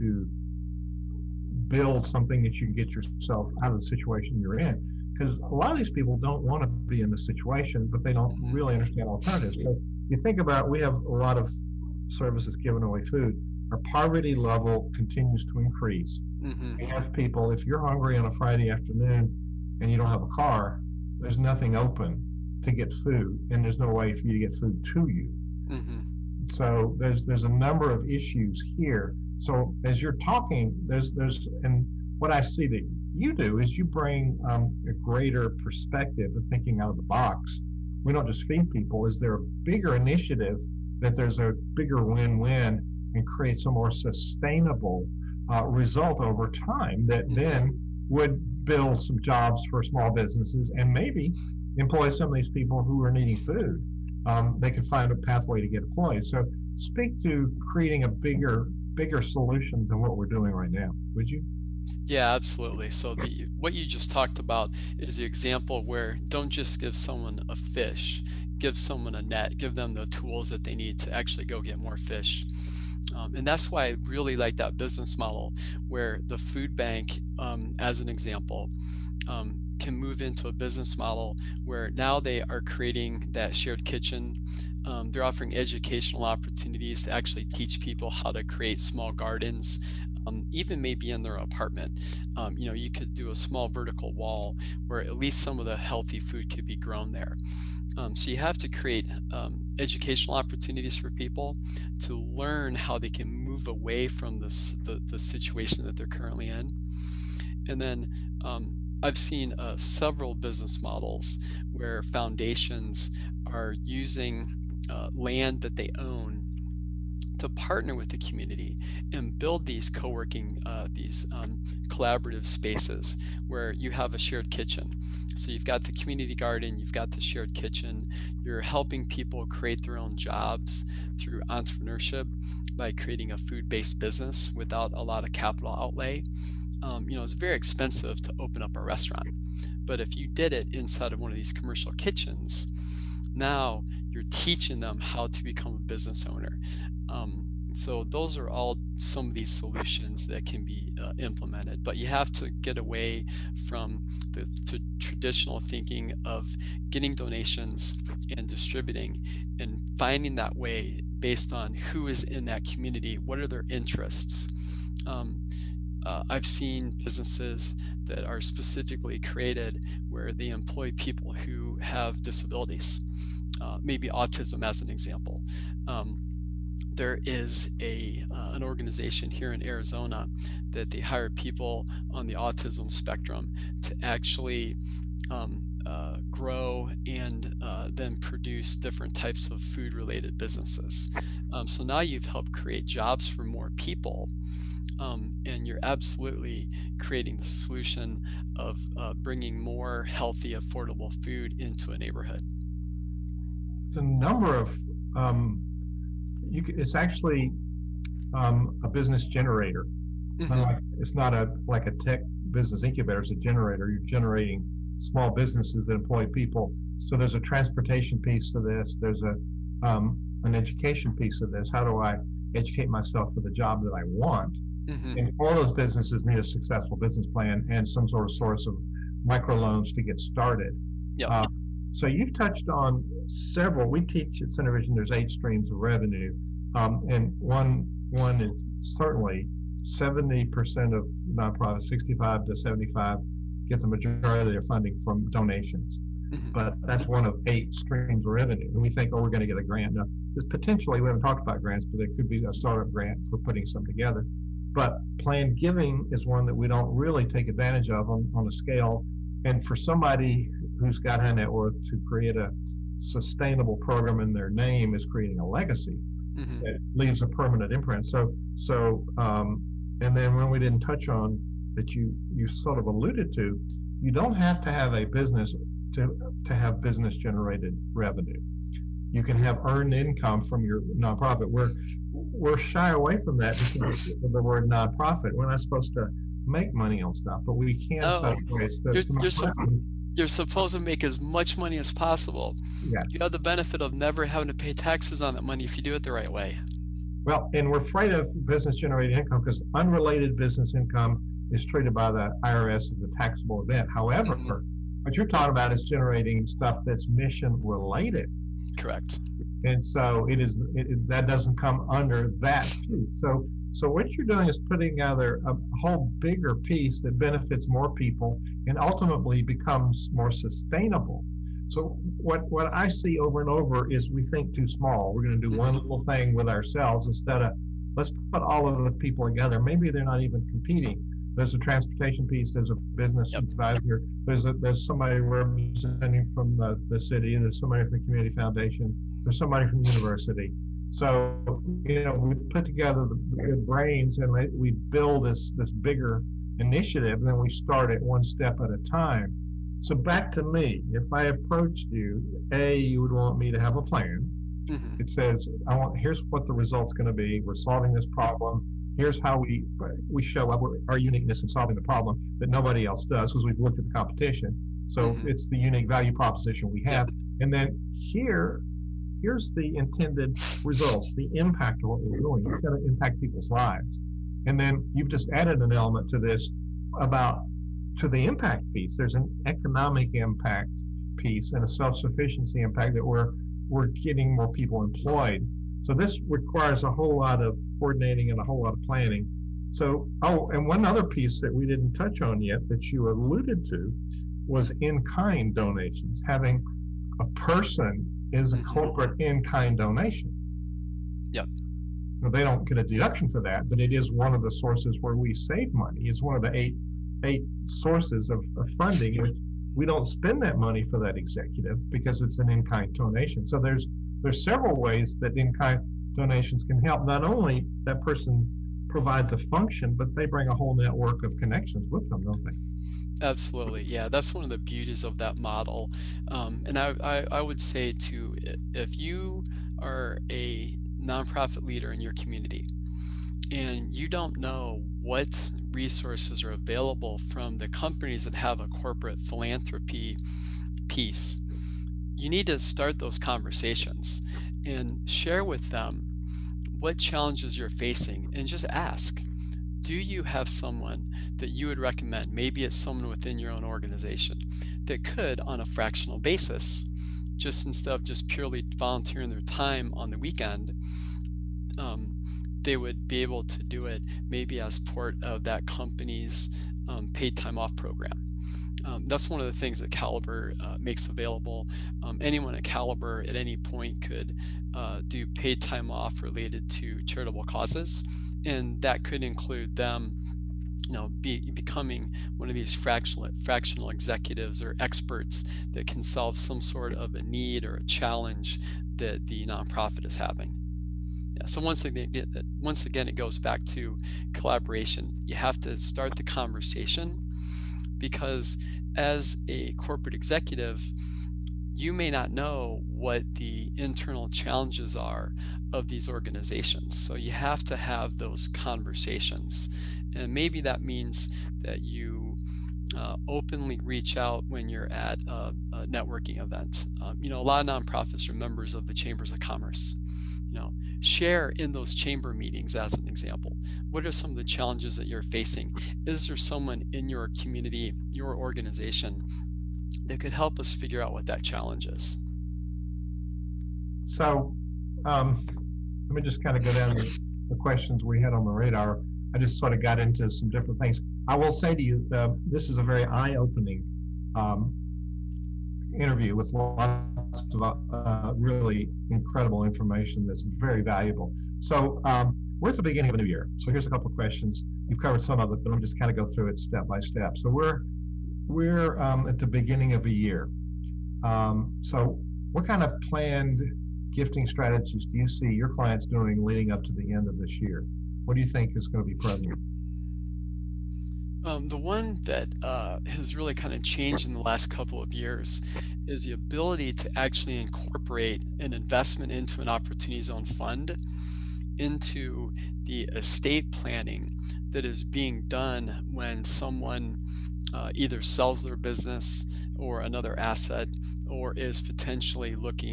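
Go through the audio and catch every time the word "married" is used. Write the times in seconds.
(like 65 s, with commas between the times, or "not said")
not said.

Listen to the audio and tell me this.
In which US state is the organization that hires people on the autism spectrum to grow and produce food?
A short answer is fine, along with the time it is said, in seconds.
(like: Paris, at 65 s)
Arizona, at 179 s.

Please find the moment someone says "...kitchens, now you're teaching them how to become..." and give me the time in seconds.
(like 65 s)
141 s.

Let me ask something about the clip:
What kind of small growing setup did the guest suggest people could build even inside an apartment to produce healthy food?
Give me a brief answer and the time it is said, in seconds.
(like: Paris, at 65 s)
vertical wall, at 93 s.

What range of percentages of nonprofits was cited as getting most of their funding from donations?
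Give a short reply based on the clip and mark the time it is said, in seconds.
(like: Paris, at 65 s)
65 to 75, at 241 s.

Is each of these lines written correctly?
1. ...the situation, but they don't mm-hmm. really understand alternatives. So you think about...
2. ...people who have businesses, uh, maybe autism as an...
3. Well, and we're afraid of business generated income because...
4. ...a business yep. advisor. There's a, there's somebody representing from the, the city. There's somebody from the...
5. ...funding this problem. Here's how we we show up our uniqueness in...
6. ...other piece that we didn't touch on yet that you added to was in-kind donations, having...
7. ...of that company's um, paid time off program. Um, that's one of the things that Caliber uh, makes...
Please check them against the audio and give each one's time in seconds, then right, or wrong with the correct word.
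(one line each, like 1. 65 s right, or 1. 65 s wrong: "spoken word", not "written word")
1. 7 s right
2. 170 s wrong: "disabilities", not "businesses"
3. 297 s right
4. 332 s right
5. 357 s wrong: "solving", not "funding"
6. 390 s wrong: "alluded", not "added"
7. 465 s right.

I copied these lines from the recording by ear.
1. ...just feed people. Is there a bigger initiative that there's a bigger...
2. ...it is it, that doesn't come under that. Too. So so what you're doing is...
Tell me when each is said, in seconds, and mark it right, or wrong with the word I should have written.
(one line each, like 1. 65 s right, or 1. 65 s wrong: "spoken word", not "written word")
1. 38 s right
2. 310 s right.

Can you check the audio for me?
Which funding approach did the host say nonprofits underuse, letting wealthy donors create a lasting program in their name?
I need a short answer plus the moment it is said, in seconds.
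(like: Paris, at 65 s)
planned giving, at 255 s.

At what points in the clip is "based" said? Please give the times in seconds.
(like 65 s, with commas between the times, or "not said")
133 s, 161 s.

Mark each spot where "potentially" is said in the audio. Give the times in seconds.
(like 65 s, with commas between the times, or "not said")
250 s, 591 s.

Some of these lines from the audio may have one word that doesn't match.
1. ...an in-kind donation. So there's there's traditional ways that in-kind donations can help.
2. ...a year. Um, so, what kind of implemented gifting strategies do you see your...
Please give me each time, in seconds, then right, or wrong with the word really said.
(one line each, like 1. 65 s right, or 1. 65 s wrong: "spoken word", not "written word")
1. 412 s wrong: "several", not "traditional"
2. 560 s wrong: "planned", not "implemented".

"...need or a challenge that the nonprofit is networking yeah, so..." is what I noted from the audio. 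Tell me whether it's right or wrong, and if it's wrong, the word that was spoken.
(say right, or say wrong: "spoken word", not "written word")
wrong: "having", not "networking".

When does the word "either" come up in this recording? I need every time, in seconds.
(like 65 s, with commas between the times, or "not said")
587 s.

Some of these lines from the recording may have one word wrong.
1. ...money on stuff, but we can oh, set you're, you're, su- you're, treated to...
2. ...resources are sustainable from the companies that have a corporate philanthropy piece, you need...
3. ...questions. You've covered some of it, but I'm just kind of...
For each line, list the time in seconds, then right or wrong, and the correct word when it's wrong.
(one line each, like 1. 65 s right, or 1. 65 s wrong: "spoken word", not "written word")
1. 286 s wrong: "supposed", not "treated"
2. 435 s wrong: "available", not "sustainable"
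3. 554 s right.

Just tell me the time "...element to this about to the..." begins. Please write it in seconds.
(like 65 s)
375 s.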